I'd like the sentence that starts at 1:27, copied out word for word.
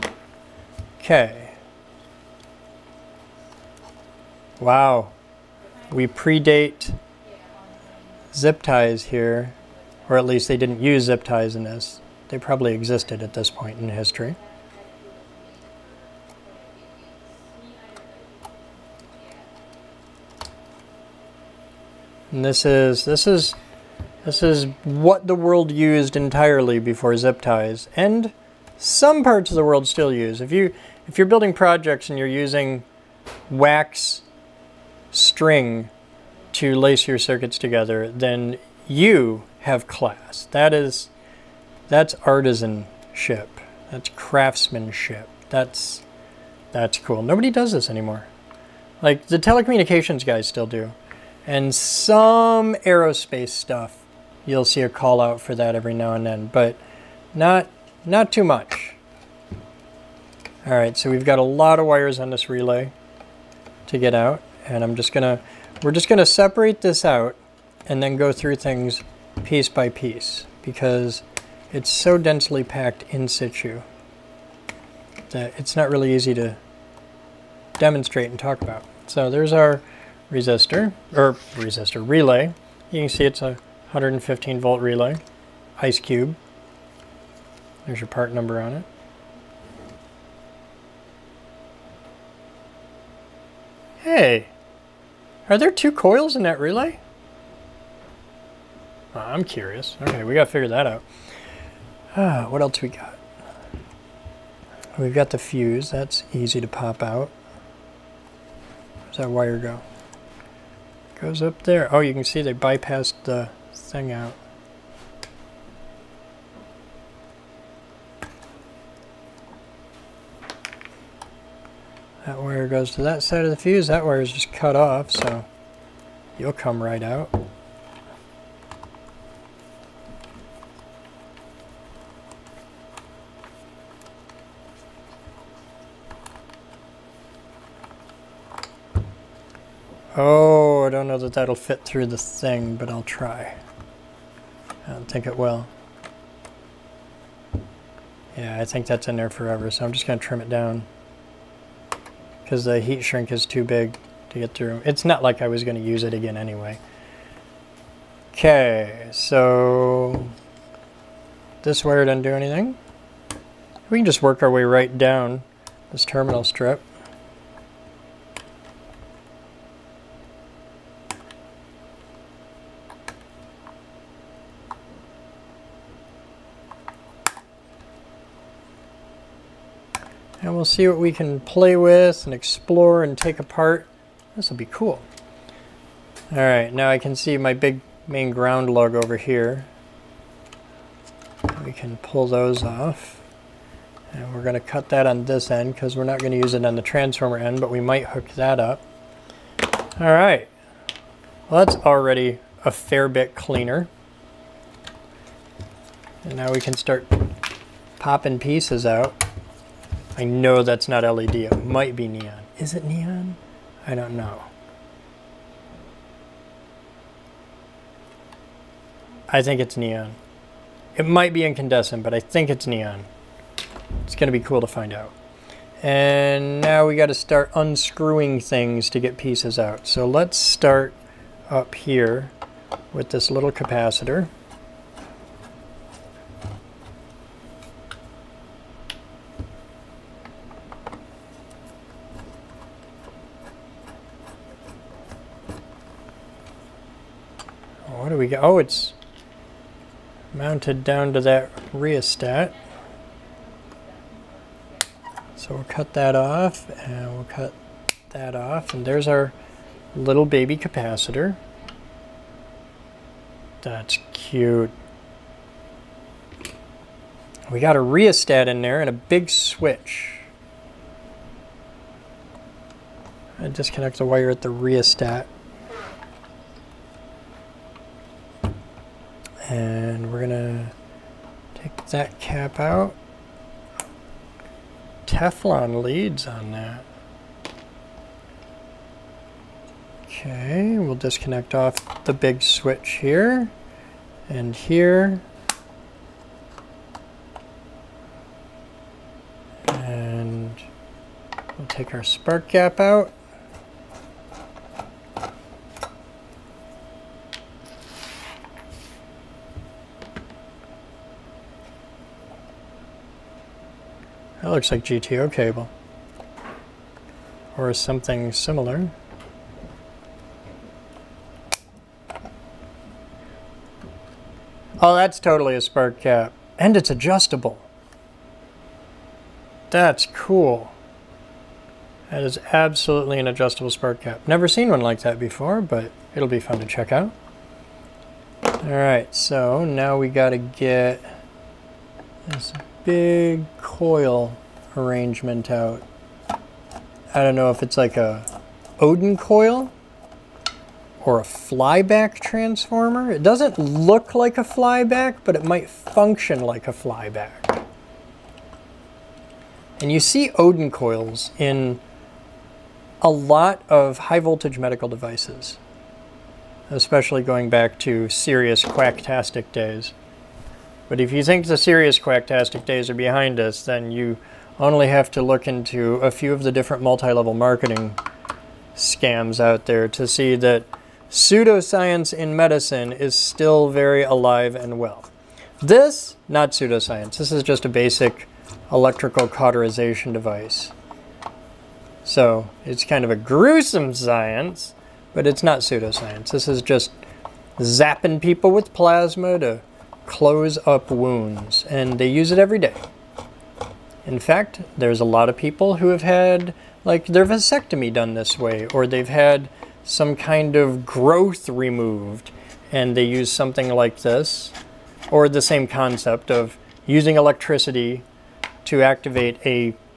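There's your part number on it.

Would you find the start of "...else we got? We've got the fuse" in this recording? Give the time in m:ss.
1:42.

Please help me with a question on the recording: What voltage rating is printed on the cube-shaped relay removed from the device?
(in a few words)
115 volt.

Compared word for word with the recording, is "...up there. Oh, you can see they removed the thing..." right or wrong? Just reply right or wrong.
wrong.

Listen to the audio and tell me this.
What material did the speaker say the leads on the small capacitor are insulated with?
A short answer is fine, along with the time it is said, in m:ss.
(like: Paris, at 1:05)
Teflon, at 4:45.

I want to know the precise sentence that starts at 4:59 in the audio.
And we'll take our spark gap out.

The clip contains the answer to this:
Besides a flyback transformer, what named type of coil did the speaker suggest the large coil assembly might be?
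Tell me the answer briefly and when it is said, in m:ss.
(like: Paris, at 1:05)
Oudin coil, at 5:48.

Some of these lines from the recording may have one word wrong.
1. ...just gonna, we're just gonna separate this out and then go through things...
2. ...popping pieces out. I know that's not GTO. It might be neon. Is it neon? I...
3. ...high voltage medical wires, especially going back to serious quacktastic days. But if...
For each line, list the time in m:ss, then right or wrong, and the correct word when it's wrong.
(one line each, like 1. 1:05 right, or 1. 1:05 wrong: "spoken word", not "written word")
1. 1:04 right
2. 3:27 wrong: "LED", not "GTO"
3. 6:03 wrong: "devices", not "wires".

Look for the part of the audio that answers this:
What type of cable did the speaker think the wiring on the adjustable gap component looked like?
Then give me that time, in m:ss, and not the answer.
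5:14.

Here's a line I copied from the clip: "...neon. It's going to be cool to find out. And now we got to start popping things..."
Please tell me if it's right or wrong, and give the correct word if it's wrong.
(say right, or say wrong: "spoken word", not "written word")
wrong: "unscrewing", not "popping".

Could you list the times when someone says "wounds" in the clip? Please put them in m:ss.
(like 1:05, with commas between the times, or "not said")
6:40.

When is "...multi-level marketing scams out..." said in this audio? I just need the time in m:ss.
6:16.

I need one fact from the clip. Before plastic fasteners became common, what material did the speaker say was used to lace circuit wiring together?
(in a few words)
wax string.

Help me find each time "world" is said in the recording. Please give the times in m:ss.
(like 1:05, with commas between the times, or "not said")
0:25, 0:29.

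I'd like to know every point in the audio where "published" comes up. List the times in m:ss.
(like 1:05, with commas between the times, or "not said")
not said.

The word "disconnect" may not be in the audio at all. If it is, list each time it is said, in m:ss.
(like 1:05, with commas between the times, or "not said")
4:33, 4:50.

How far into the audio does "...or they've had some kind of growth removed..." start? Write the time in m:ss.
6:48.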